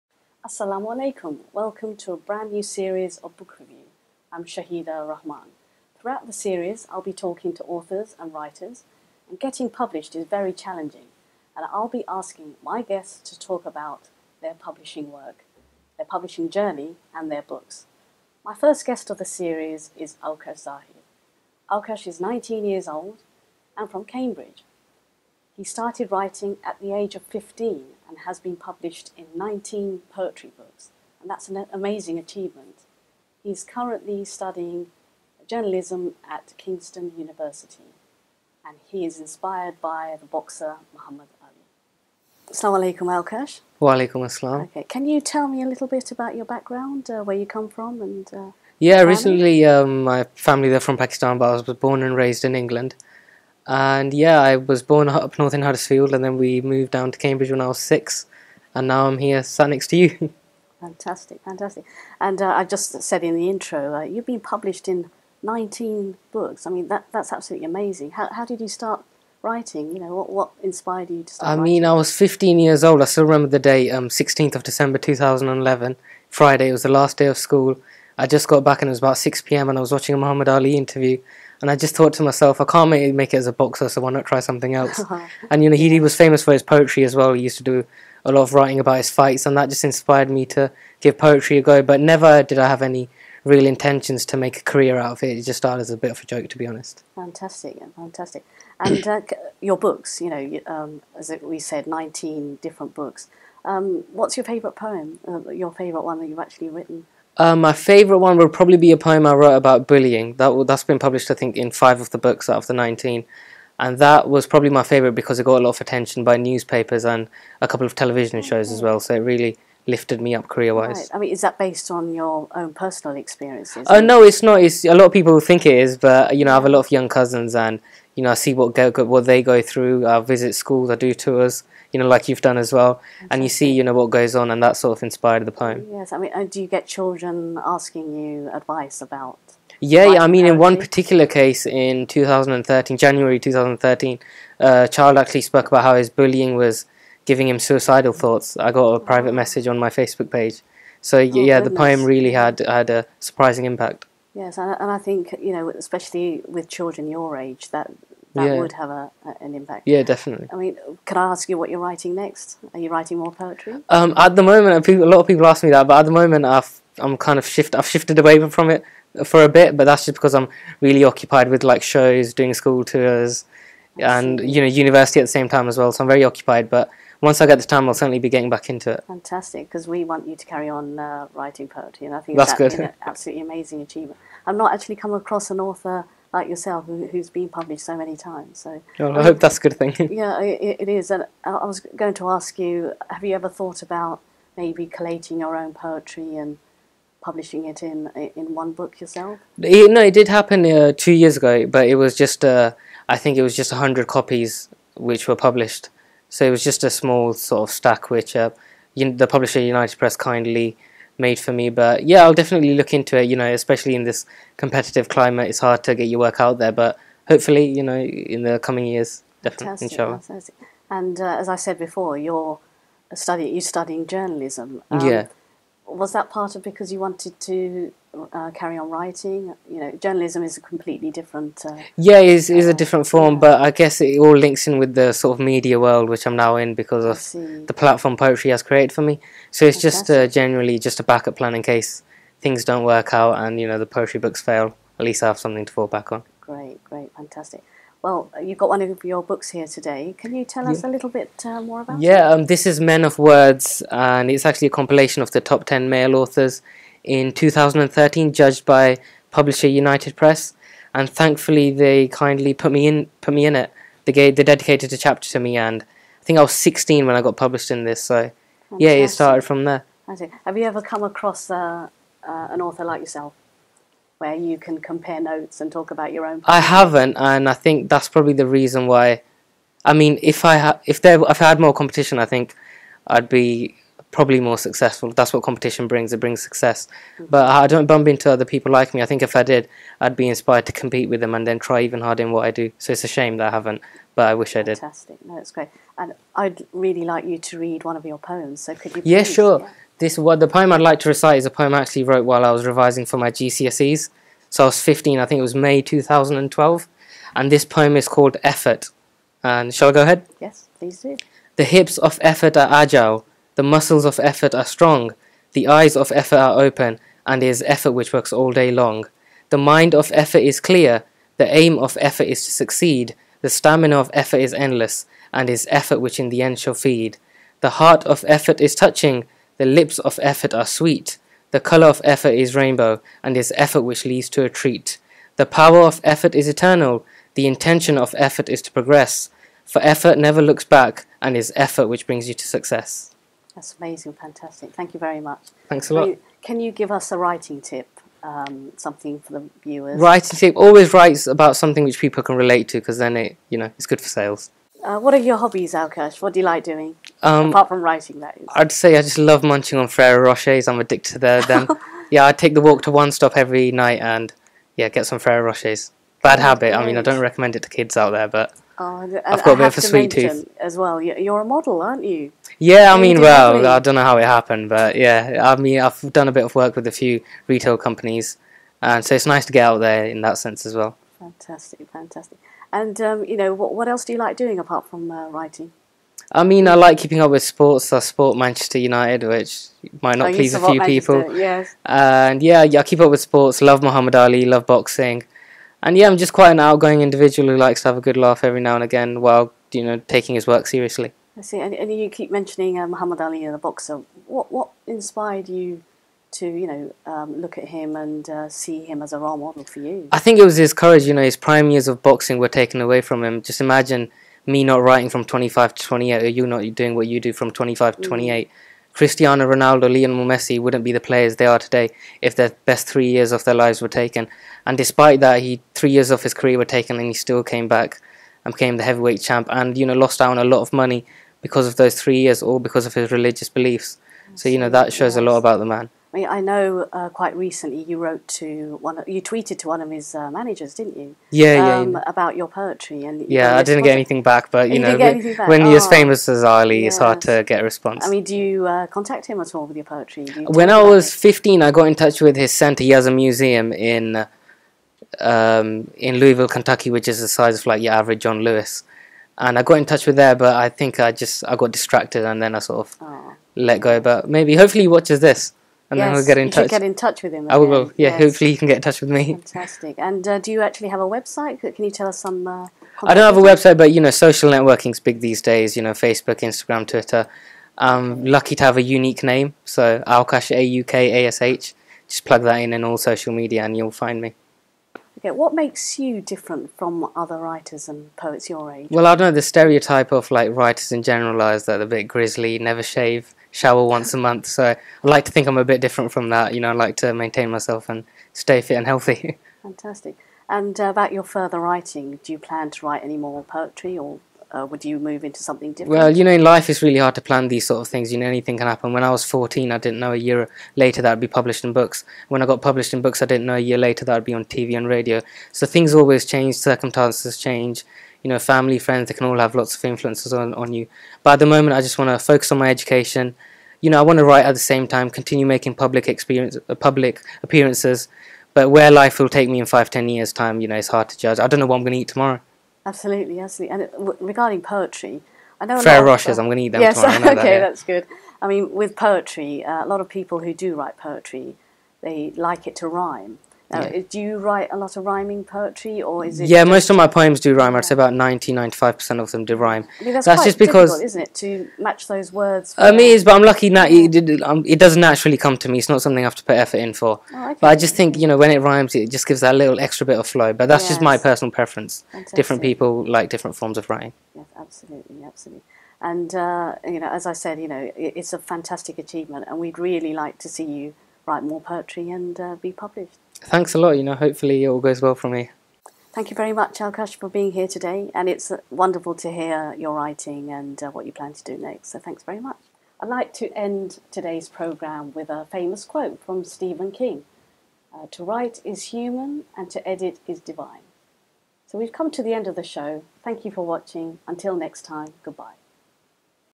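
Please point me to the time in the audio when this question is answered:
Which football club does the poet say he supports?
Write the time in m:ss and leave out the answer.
6:28.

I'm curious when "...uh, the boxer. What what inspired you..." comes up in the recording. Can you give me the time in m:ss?
6:43.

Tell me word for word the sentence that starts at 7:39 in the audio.
And I got in touch with there, but I think I just I got distracted and then I sort of oh.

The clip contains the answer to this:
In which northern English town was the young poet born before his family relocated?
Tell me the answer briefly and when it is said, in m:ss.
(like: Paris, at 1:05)
Huddersfield, at 0:55.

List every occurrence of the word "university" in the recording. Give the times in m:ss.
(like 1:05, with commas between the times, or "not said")
0:37, 2:54.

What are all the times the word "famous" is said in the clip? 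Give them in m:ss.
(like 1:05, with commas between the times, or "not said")
1:26, 7:25, 9:45.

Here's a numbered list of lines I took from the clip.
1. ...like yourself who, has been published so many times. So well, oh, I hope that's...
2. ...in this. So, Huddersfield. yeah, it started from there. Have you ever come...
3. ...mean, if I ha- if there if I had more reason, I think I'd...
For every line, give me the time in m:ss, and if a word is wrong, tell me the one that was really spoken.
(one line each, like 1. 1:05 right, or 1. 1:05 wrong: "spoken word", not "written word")
1. 3:06 right
2. 4:27 wrong: "Fantastic", not "Huddersfield"
3. 4:39 wrong: "competition", not "reason".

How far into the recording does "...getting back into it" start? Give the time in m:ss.
2:58.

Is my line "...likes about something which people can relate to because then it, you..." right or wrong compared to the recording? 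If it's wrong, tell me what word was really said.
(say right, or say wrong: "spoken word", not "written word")
wrong: "writes", not "likes".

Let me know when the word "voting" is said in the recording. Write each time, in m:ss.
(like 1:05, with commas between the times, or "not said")
not said.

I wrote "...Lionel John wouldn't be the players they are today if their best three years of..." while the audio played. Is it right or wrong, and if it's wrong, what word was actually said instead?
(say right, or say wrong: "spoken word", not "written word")
wrong: "Messi", not "John".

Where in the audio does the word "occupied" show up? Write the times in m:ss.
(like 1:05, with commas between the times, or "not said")
2:51, 2:56.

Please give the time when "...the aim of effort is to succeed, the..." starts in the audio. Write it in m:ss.
5:21.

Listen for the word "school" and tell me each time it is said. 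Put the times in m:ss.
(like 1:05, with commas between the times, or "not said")
1:17, 2:10, 2:52.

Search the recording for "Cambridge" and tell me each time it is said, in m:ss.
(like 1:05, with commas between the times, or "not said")
0:24, 0:57.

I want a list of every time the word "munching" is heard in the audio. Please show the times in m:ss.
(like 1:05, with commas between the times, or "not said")
5:59.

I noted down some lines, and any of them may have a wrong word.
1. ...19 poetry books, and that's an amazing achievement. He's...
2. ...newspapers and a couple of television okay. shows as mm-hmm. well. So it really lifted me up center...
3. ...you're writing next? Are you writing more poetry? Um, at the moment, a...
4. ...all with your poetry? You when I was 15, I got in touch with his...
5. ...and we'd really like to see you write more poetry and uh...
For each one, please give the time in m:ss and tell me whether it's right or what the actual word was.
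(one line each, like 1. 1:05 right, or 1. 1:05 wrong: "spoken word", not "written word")
1. 0:29 right
2. 1:56 wrong: "career", not "center"
3. 2:41 right
4. 7:29 right
5. 9:29 right.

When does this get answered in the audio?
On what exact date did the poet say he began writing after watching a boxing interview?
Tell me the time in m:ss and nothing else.
1:14.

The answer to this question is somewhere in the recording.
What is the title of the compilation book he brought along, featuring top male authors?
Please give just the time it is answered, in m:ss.
4:12.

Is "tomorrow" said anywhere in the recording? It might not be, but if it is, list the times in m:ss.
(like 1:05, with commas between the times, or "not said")
8:52, 8:57.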